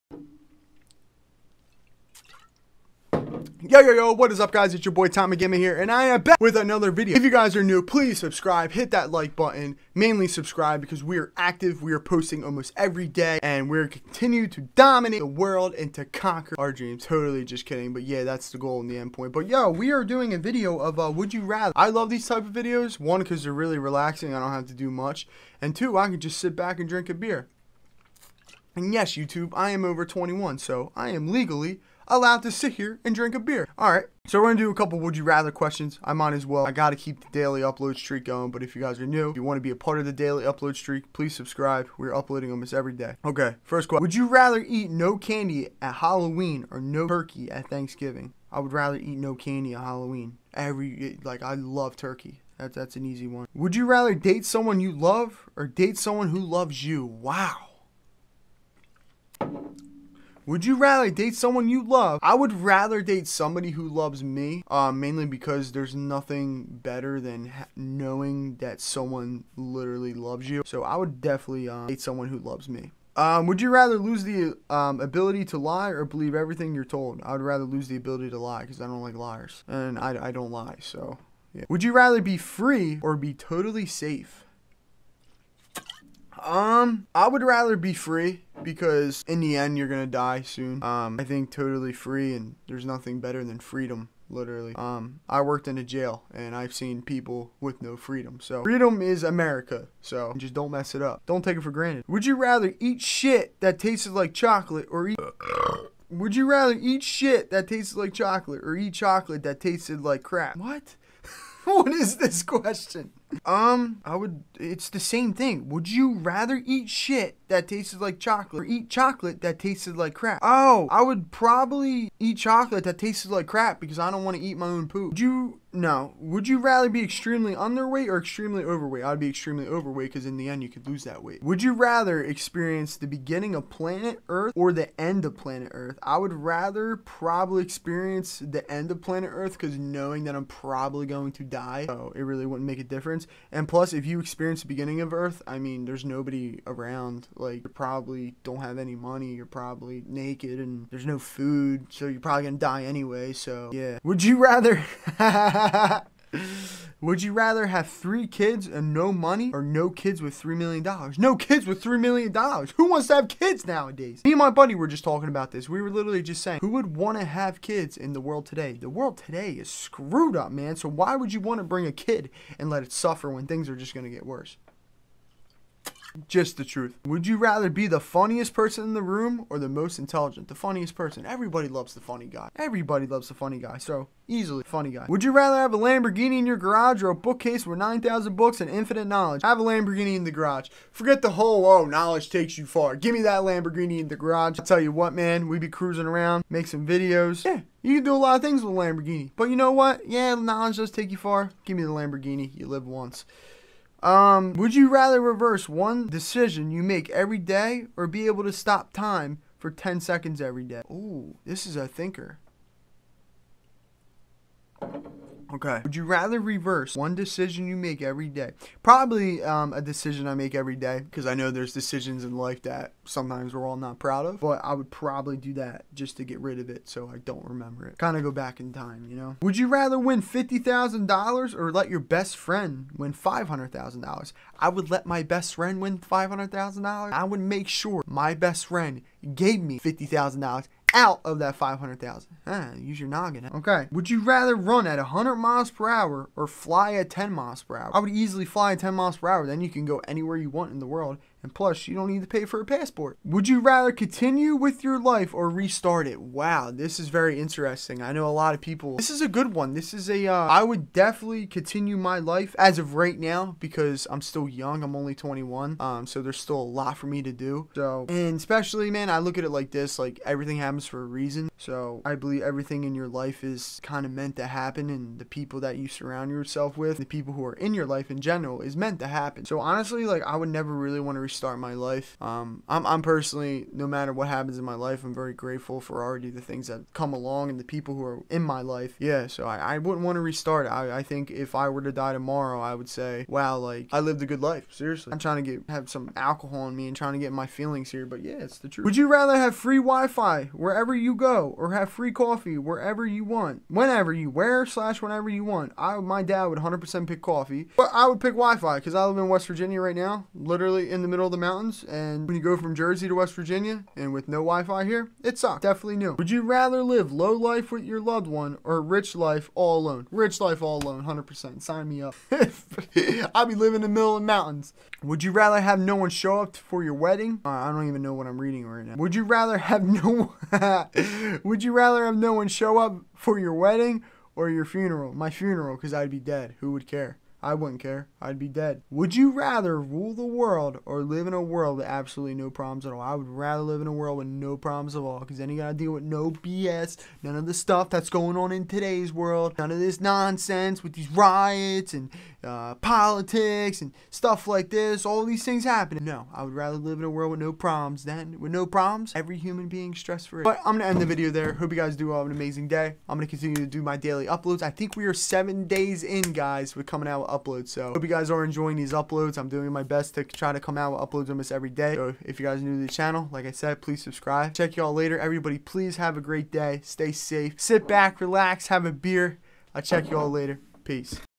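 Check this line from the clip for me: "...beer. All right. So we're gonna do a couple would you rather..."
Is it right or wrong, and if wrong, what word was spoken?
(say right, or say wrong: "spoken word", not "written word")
right.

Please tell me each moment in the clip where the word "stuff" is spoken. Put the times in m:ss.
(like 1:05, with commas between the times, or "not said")
5:47, 5:54.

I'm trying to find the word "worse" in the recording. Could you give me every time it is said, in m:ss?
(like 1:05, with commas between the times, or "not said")
2:54.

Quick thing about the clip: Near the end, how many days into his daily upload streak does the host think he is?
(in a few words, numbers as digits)
7.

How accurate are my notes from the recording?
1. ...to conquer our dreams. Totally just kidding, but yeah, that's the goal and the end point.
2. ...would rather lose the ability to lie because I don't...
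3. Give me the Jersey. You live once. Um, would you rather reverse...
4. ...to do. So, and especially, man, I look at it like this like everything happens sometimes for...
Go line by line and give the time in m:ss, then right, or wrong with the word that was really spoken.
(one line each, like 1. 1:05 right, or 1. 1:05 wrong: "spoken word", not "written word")
1. 0:15 right
2. 1:17 right
3. 3:21 wrong: "Lamborghini", not "Jersey"
4. 4:27 wrong: "comes", not "sometimes".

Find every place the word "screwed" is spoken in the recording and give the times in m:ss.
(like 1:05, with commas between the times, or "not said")
2:49.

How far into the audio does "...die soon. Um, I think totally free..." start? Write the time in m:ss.
1:30.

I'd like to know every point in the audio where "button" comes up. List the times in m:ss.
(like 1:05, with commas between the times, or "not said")
0:09.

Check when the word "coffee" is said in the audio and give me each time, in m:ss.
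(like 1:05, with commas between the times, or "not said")
5:02, 5:07.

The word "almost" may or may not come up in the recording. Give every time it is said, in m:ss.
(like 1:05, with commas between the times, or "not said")
0:12, 0:42, 6:11.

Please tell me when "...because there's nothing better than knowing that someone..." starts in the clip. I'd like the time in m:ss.
1:05.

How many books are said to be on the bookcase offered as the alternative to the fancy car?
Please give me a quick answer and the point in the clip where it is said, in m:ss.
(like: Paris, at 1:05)
9,000, at 3:07.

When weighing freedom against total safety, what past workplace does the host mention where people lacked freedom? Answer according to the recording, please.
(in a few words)
jail.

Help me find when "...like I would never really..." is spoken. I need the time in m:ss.
4:40.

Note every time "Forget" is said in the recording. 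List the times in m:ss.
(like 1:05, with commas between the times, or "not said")
3:10.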